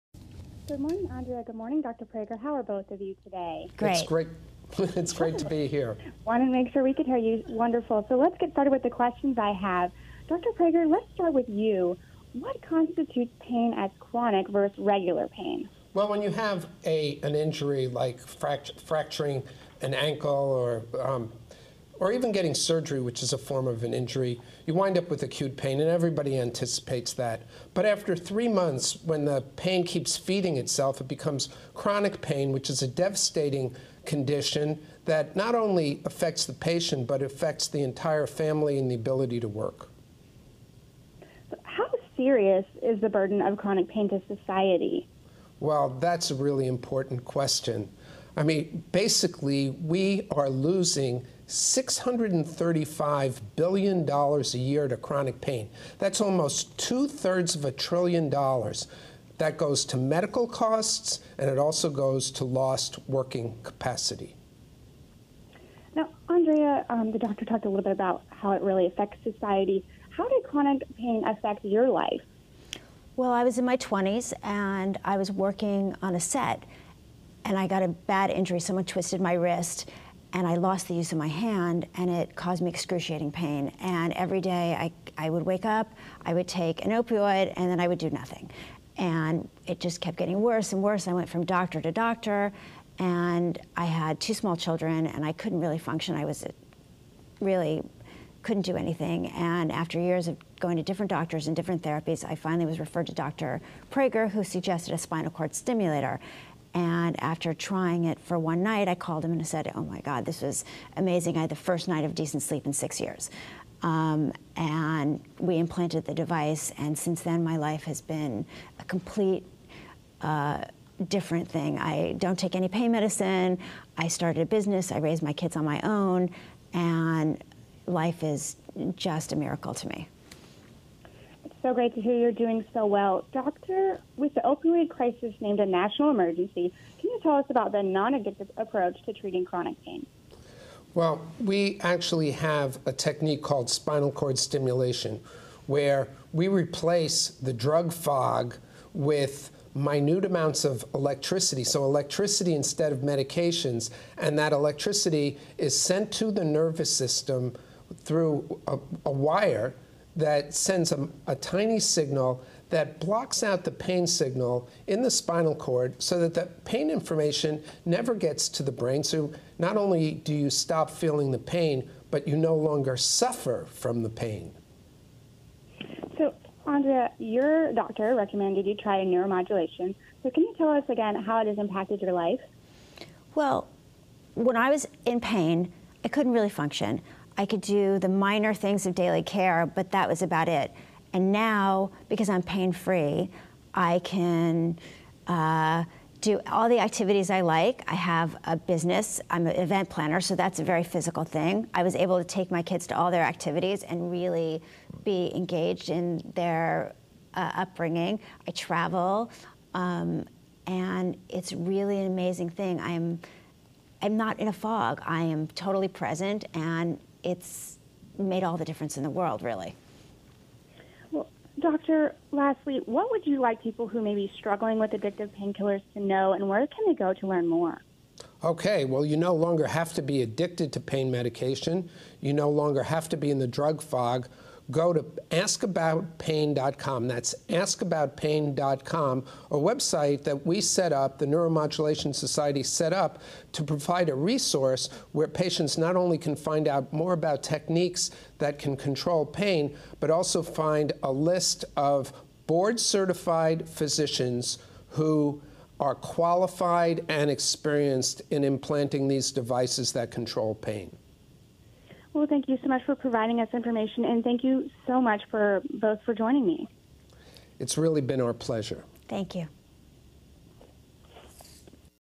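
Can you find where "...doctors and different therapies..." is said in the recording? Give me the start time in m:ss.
1:41.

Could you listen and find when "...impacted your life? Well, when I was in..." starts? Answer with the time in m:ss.
3:01.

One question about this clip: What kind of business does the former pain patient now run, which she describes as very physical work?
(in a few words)
Event planner.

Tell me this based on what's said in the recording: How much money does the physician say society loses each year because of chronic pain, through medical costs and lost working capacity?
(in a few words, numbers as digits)
$635 billion.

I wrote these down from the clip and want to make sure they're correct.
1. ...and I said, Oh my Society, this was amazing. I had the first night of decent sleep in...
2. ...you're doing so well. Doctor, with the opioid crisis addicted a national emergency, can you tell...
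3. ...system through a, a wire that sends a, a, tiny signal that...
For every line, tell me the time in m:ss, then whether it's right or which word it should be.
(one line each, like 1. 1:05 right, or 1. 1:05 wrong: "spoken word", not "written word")
1. 1:49 wrong: "God", not "Society"
2. 2:12 wrong: "named", not "addicted"
3. 2:36 right.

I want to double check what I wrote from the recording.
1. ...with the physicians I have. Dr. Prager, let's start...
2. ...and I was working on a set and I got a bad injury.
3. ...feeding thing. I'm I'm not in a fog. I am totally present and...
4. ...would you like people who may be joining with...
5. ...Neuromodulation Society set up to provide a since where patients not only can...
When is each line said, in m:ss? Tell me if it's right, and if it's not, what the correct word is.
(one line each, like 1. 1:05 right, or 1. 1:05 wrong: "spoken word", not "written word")
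1. 0:08 wrong: "questions", not "physicians"
2. 1:14 right
3. 3:32 wrong: "amazing", not "feeding"
4. 3:43 wrong: "struggling", not "joining"
5. 4:01 wrong: "resource", not "since".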